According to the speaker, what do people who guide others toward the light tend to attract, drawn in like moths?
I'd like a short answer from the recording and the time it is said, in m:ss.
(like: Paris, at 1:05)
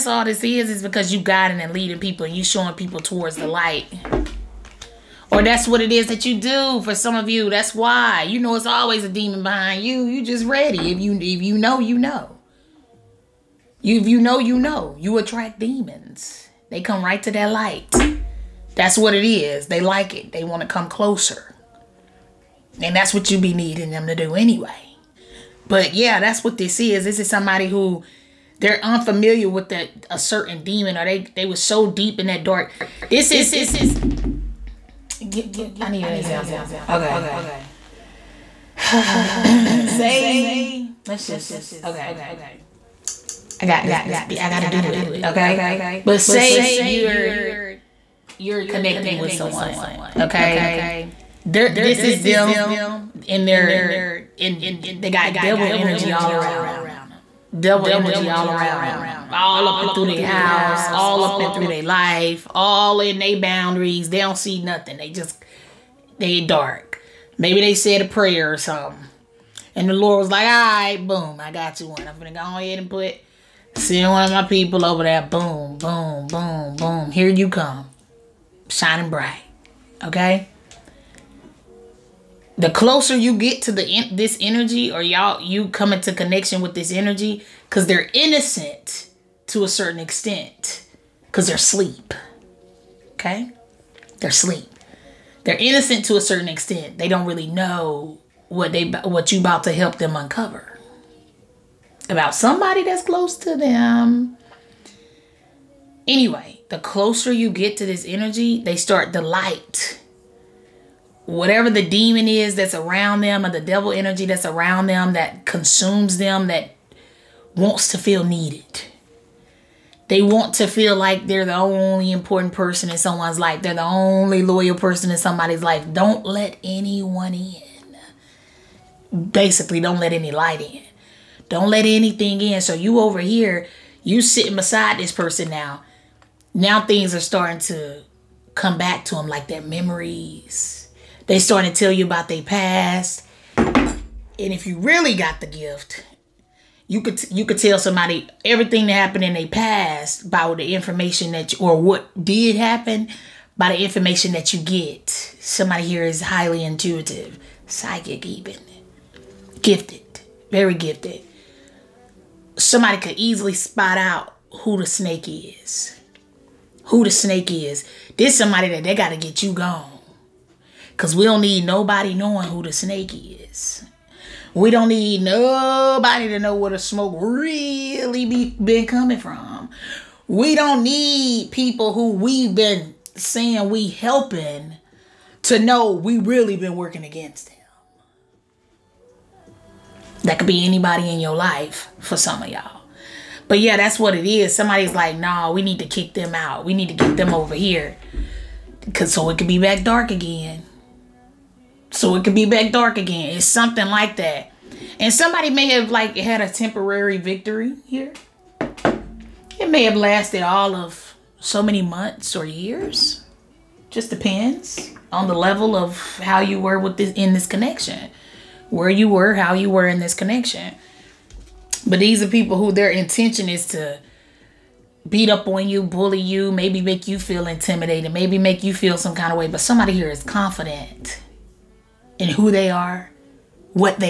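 Demons, at 0:14.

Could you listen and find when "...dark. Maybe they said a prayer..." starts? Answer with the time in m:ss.
1:06.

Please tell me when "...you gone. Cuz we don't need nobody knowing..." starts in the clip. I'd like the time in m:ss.
2:49.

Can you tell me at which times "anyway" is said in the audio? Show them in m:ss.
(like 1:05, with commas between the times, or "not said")
0:24, 1:46.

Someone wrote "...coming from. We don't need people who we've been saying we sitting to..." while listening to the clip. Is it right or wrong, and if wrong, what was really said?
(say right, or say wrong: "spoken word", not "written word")
wrong: "helping", not "sitting".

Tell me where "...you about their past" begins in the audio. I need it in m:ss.
2:21.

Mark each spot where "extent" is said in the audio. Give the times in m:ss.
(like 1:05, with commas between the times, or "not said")
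1:29, 1:36.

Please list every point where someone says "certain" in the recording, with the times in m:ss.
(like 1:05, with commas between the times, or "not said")
0:30, 1:29, 1:36.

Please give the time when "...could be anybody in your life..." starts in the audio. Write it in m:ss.
3:10.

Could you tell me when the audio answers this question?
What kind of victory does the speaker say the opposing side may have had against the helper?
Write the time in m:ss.
3:26.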